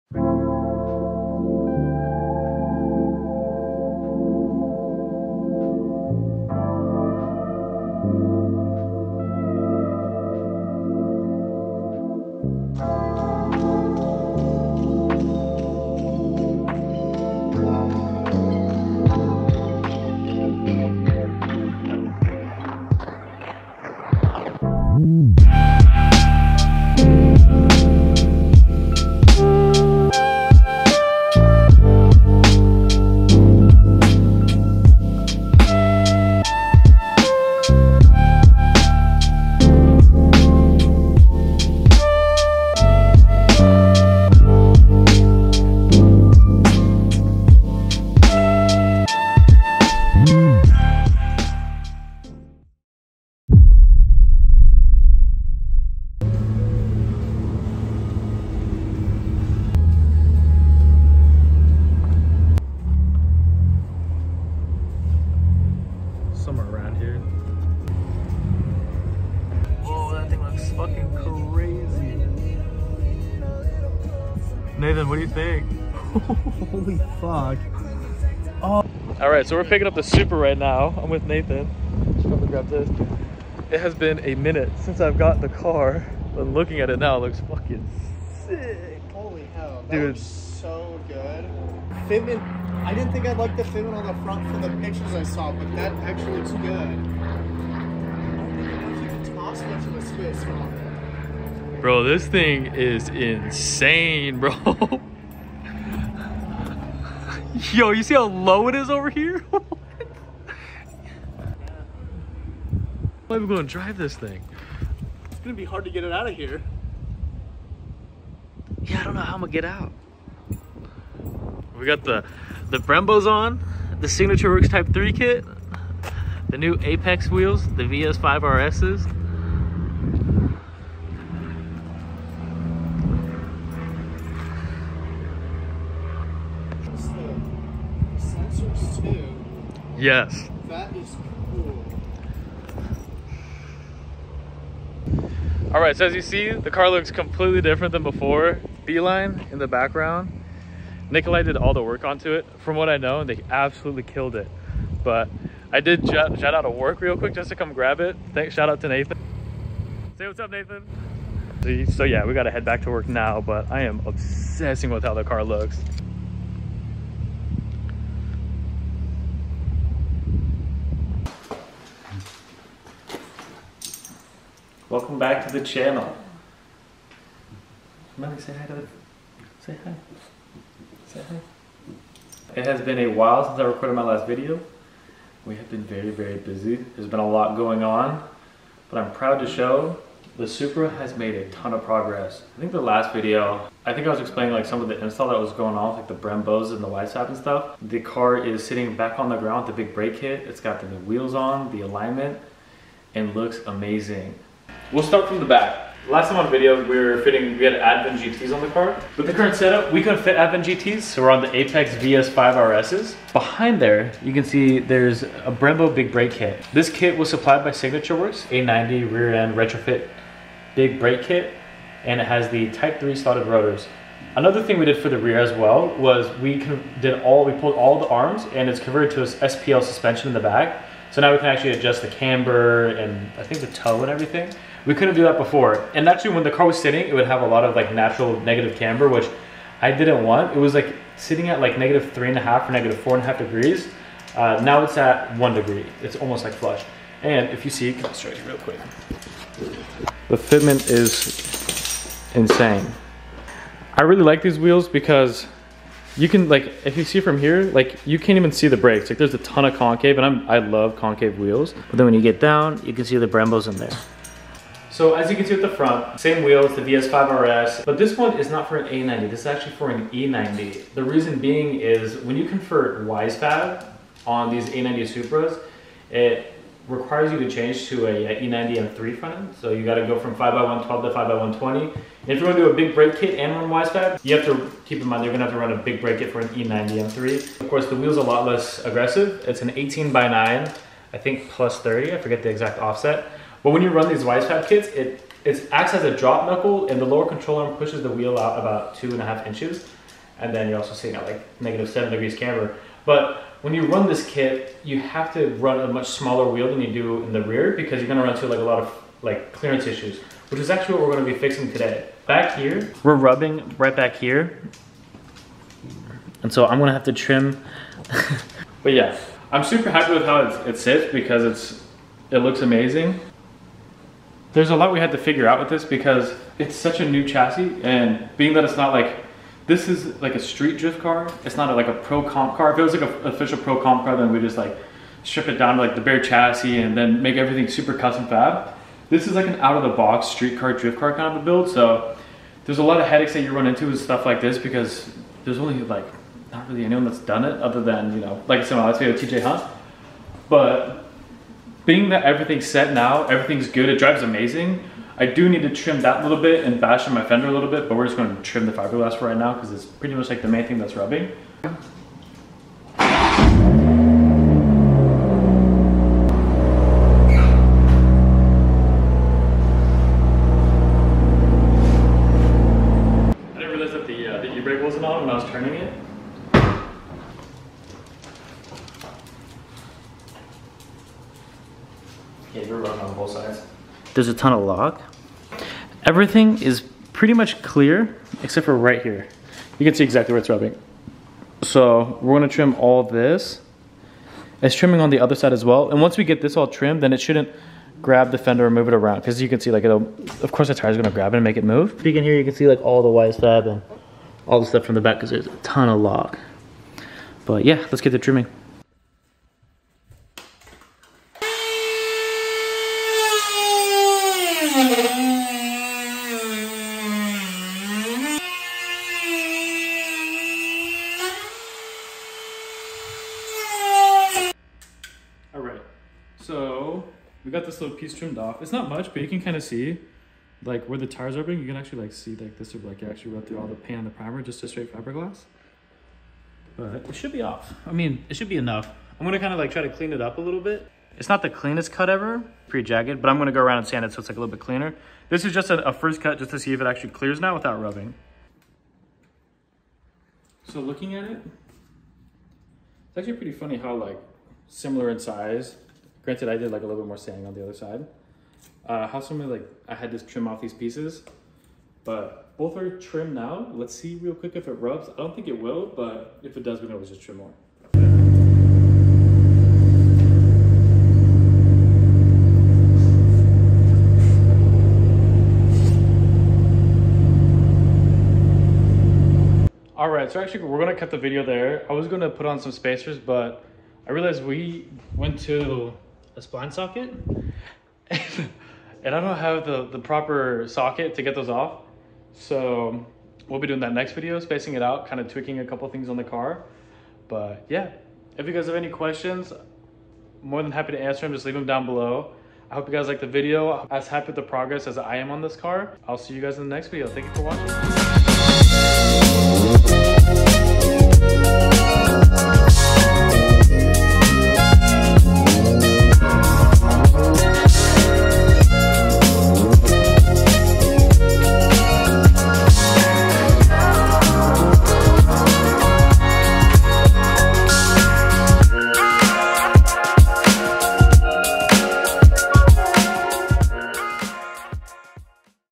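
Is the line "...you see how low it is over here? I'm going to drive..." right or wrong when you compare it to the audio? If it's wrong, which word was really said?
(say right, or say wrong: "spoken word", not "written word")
right.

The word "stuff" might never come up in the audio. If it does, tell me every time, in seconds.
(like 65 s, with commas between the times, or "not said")
197 s, 344 s, 404 s.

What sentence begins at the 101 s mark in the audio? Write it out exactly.
Bro, this thing is insane, bro.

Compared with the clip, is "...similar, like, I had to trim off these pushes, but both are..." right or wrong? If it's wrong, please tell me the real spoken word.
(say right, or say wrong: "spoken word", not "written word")
wrong: "pieces", not "pushes".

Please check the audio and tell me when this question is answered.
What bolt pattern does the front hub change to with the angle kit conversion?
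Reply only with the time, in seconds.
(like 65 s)
281 s.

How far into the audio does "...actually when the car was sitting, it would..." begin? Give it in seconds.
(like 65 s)
236 s.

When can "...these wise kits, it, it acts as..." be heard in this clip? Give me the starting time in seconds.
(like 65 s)
294 s.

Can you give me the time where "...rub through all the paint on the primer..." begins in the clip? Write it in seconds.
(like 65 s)
433 s.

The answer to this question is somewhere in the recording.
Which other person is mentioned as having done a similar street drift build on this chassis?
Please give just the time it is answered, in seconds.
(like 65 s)
349 s.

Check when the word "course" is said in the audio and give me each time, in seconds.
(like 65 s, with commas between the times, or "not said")
287 s, 400 s.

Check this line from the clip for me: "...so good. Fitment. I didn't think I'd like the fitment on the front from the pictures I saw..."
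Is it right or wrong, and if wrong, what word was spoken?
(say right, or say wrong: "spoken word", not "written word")
right.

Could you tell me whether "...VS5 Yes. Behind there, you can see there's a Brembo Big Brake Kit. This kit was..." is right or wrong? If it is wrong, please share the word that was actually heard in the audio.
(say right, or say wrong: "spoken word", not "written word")
wrong: "RSs", not "Yes".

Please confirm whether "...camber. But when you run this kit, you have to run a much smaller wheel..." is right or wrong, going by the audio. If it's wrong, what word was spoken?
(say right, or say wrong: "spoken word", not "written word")
right.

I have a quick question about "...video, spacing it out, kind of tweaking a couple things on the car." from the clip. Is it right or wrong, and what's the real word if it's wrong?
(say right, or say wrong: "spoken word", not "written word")
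right.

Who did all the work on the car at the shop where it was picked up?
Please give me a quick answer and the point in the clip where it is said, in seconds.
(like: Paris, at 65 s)
Nikolai, at 151 s.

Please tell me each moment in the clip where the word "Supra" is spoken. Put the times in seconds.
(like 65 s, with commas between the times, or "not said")
80 s, 190 s, 275 s.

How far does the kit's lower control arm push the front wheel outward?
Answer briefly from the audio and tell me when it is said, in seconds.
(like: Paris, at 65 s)
2.5 inches, at 298 s.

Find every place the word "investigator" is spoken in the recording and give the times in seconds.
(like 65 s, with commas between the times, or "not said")
not said.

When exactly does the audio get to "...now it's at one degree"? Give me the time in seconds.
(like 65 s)
244 s.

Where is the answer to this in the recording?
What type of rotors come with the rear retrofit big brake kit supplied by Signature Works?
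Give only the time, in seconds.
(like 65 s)
222 s.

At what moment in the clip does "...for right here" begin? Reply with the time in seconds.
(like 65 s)
388 s.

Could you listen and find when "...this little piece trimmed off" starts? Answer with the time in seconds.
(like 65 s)
427 s.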